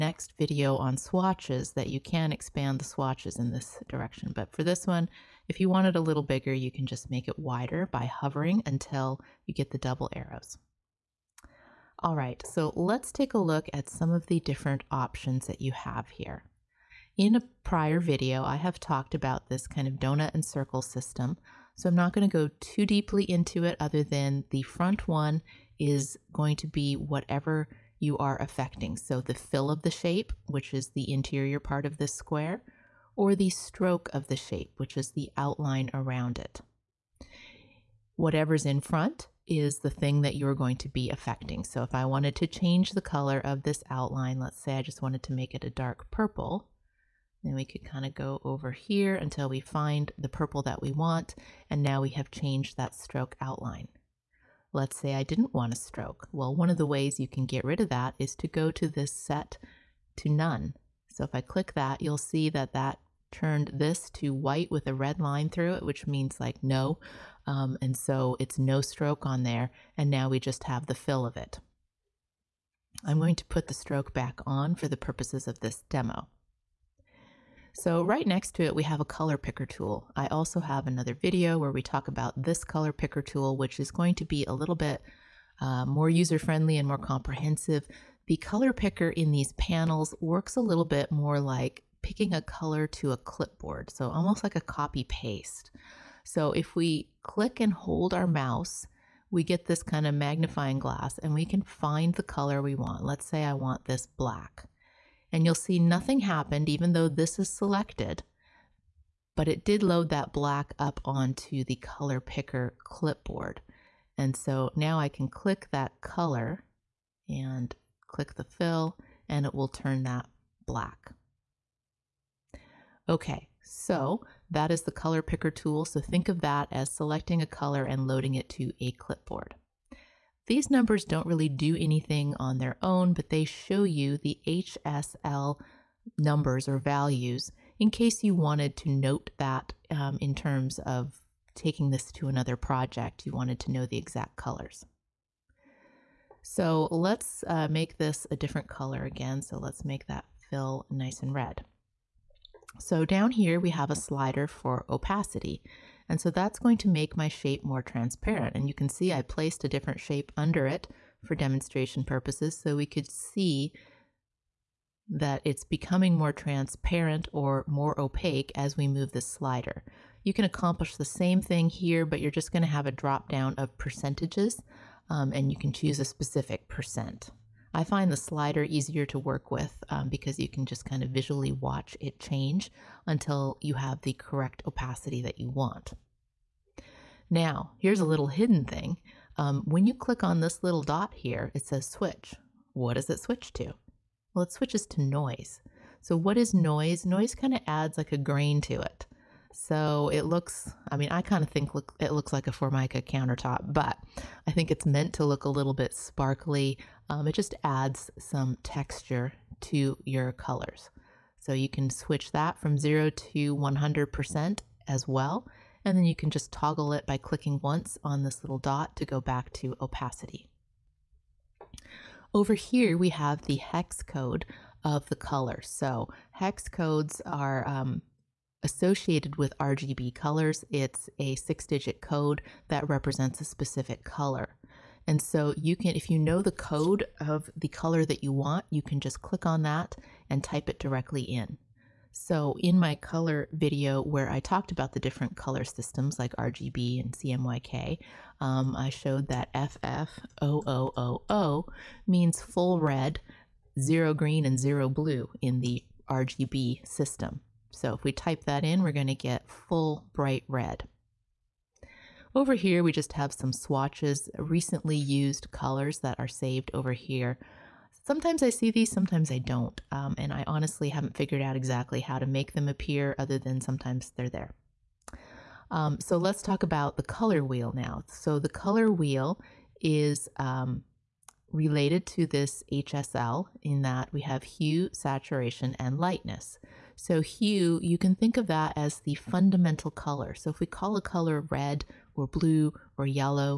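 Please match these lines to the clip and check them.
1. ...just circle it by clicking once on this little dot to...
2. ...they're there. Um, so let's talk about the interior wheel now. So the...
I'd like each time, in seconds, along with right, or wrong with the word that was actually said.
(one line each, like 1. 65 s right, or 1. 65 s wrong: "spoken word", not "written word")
1. 216 s wrong: "toggle", not "circle"
2. 274 s wrong: "color", not "interior".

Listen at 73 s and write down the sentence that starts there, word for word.
I'm going to put the stroke back on for the purposes of this demo.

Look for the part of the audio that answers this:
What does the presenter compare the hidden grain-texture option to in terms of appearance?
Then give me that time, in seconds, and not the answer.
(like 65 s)
202 s.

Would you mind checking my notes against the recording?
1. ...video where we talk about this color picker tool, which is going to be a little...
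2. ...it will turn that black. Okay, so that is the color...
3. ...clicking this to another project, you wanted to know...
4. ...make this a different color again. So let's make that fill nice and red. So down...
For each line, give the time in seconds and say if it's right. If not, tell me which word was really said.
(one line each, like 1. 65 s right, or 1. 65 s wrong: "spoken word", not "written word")
1. 81 s right
2. 119 s right
3. 141 s wrong: "taking", not "clicking"
4. 147 s right.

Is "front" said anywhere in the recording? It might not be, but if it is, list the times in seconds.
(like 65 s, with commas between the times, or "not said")
24 s, 38 s.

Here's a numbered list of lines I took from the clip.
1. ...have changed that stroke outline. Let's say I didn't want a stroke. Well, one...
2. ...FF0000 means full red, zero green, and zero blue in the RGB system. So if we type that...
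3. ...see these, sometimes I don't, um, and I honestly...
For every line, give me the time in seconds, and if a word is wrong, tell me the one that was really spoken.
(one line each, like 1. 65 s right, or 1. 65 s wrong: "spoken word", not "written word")
1. 52 s right
2. 249 s right
3. 268 s right.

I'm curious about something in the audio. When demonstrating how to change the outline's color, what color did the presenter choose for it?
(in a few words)
dark purple.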